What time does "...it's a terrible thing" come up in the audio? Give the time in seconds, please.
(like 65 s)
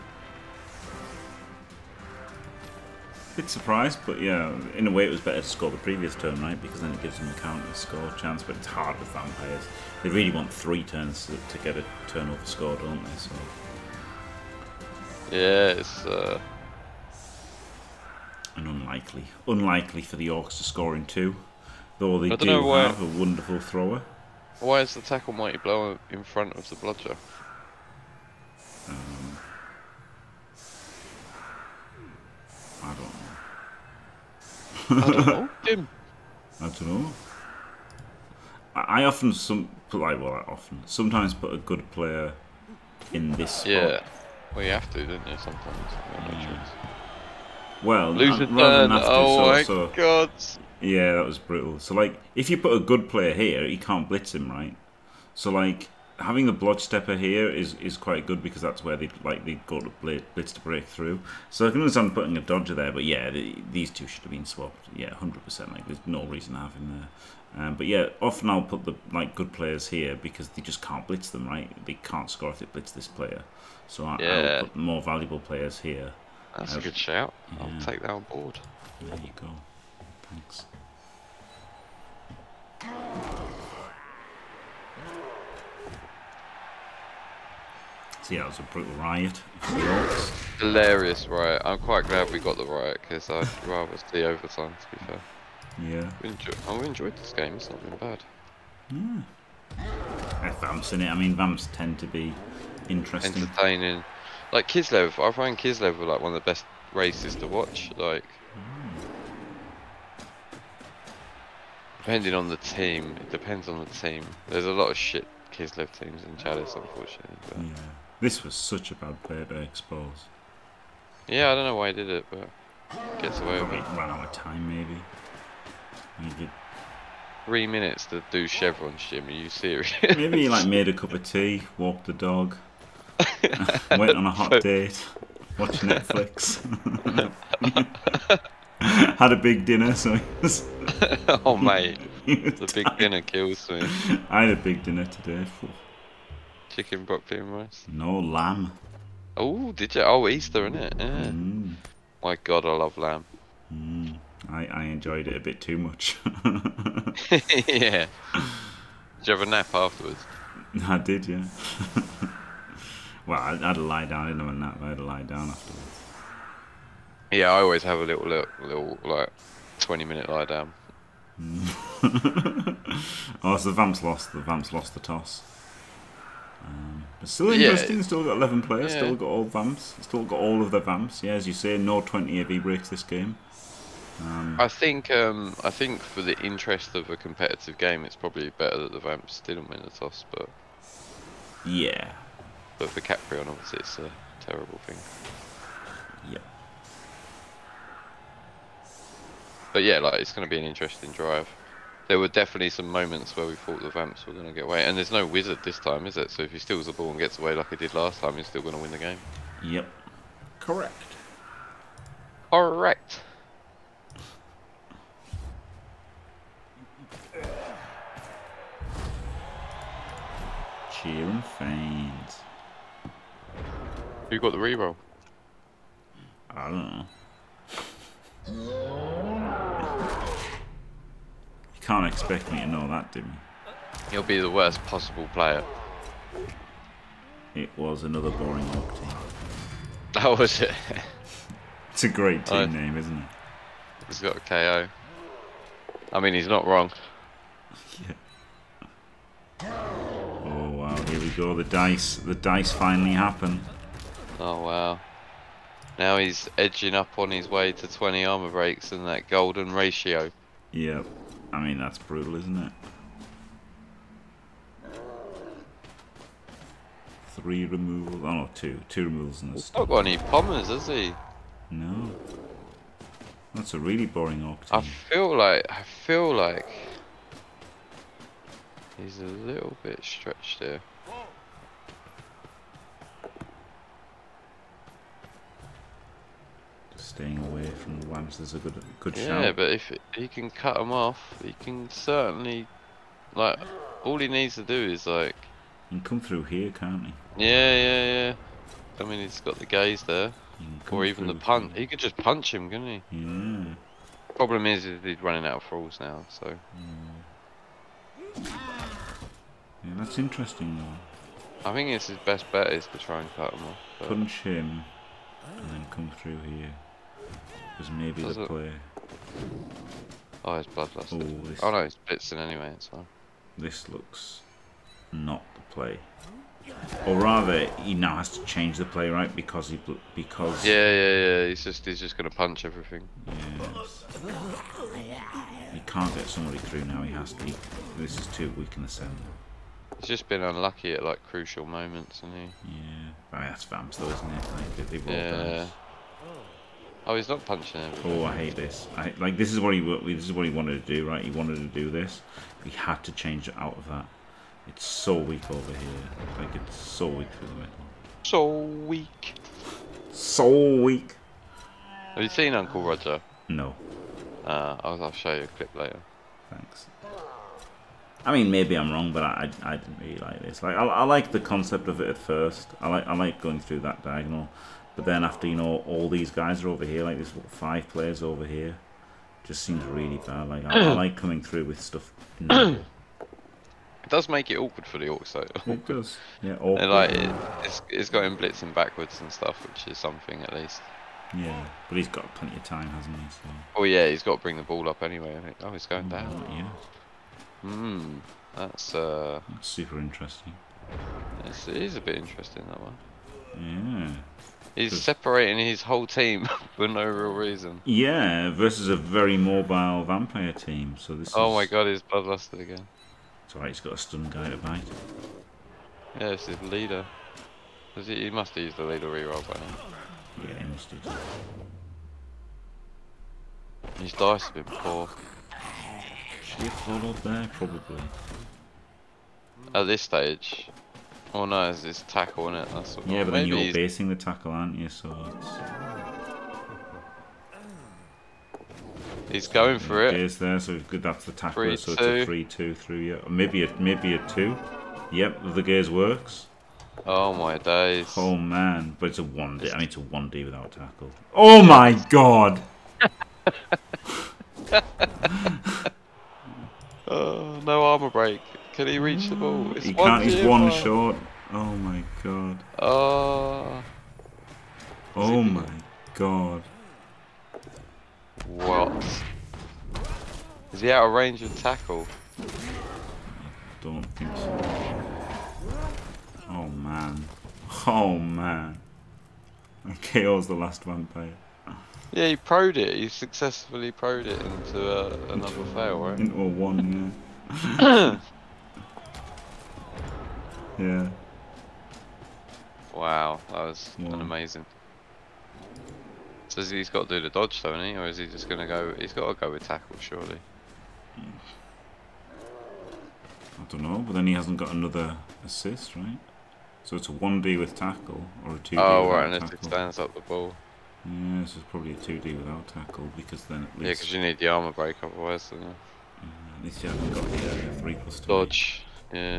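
193 s.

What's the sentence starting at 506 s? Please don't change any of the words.
So it's a 1D with tackle, or a 2D oh, without right, tackle.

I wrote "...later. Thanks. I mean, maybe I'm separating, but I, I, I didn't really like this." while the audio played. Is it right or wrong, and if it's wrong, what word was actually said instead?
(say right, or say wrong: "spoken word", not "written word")
wrong: "wrong", not "separating".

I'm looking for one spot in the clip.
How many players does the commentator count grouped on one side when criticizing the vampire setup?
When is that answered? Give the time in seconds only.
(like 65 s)
377 s.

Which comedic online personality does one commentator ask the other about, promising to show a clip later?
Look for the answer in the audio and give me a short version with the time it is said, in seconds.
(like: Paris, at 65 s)
Uncle Roger, at 362 s.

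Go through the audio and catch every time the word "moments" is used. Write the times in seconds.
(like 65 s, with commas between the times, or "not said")
202 s, 341 s.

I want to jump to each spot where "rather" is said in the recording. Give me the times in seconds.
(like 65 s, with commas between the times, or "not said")
48 s, 93 s, 327 s.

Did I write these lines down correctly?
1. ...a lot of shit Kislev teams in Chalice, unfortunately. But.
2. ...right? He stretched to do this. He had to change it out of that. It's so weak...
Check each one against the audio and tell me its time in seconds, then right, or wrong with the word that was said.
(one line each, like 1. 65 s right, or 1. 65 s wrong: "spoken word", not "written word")
1. 114 s right
2. 351 s wrong: "wanted", not "stretched".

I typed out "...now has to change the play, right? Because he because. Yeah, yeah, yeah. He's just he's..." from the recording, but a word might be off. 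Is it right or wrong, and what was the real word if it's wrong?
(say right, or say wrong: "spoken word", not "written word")
right.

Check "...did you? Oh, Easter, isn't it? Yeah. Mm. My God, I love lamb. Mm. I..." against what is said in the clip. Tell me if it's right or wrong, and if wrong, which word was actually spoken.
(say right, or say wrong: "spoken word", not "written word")
right.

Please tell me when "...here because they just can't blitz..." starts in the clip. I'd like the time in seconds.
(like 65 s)
69 s.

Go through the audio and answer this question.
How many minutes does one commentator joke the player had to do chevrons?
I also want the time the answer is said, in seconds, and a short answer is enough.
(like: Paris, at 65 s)
3, at 127 s.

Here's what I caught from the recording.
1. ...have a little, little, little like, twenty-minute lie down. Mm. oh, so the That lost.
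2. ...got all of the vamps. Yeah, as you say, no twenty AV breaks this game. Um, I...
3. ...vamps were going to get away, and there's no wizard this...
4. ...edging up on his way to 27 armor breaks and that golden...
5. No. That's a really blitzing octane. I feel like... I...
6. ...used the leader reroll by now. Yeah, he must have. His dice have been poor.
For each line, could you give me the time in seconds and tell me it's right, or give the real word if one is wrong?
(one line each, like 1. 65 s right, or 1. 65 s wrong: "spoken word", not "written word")
1. 167 s wrong: "Vamps", not "That"
2. 180 s right
3. 203 s right
4. 256 s wrong: "20", not "27"
5. 271 s wrong: "boring", not "blitzing"
6. 418 s right.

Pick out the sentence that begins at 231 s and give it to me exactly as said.
can't expect me to know that, do you?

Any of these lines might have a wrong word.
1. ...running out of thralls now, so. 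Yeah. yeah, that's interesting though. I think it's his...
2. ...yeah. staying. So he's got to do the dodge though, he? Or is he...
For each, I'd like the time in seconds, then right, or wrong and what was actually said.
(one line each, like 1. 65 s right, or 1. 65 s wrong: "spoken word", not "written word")
1. 305 s right
2. 493 s wrong: "amazing", not "staying".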